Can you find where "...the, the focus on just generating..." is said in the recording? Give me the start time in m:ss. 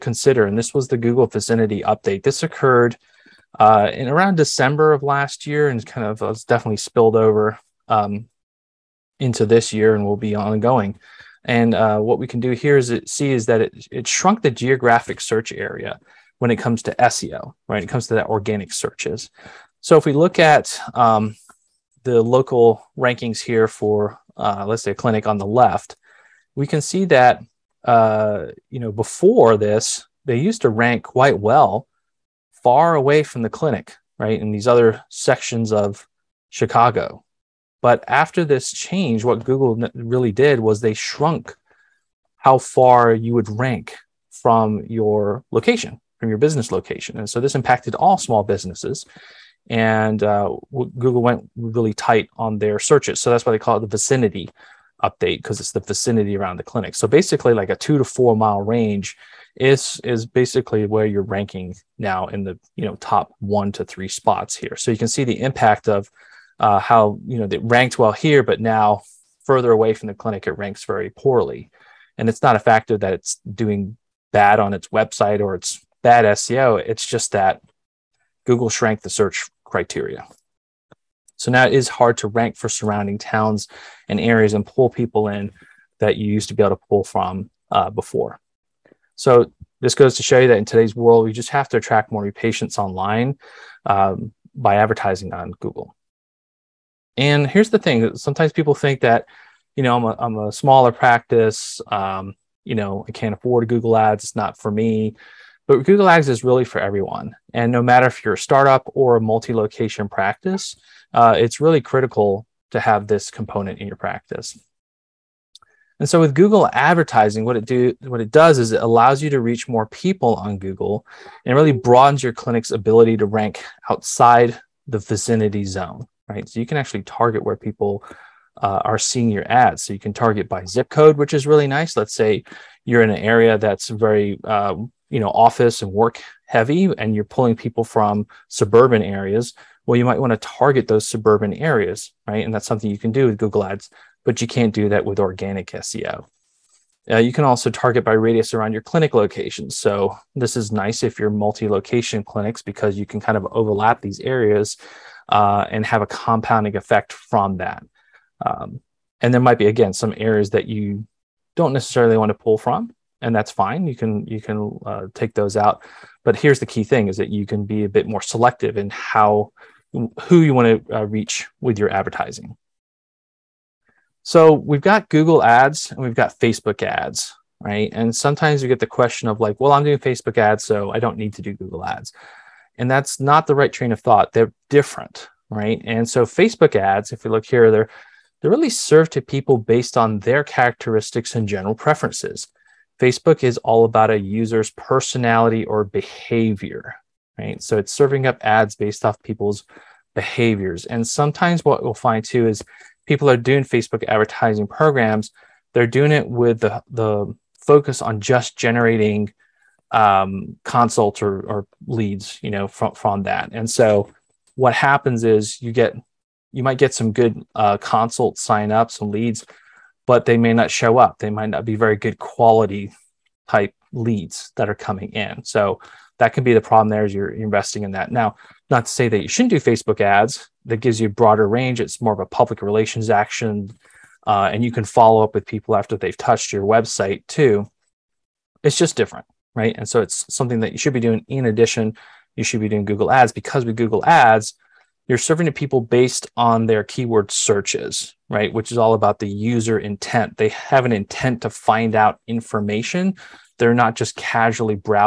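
3:26.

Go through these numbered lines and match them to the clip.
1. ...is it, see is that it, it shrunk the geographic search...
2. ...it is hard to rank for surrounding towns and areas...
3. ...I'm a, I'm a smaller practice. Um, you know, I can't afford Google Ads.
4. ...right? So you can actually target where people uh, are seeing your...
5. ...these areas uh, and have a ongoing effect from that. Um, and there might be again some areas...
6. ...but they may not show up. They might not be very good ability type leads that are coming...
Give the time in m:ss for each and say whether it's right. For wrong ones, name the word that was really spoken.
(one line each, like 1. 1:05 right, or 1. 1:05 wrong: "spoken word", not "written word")
1. 0:12 right
2. 1:21 right
3. 1:39 right
4. 2:06 right
5. 2:34 wrong: "compounding", not "ongoing"
6. 3:40 wrong: "quality", not "ability".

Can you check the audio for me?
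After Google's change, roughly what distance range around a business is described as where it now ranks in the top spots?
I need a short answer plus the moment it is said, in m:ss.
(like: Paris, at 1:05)
2 to 4 miles, at 0:57.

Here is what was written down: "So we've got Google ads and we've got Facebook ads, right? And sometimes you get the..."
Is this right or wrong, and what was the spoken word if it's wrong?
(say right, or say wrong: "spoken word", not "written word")
right.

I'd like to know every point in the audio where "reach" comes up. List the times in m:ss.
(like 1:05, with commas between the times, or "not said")
1:59, 2:51.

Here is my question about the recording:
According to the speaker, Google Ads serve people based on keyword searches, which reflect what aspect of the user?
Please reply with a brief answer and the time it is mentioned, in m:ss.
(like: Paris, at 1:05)
User intent, at 4:09.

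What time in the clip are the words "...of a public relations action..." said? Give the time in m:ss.
3:52.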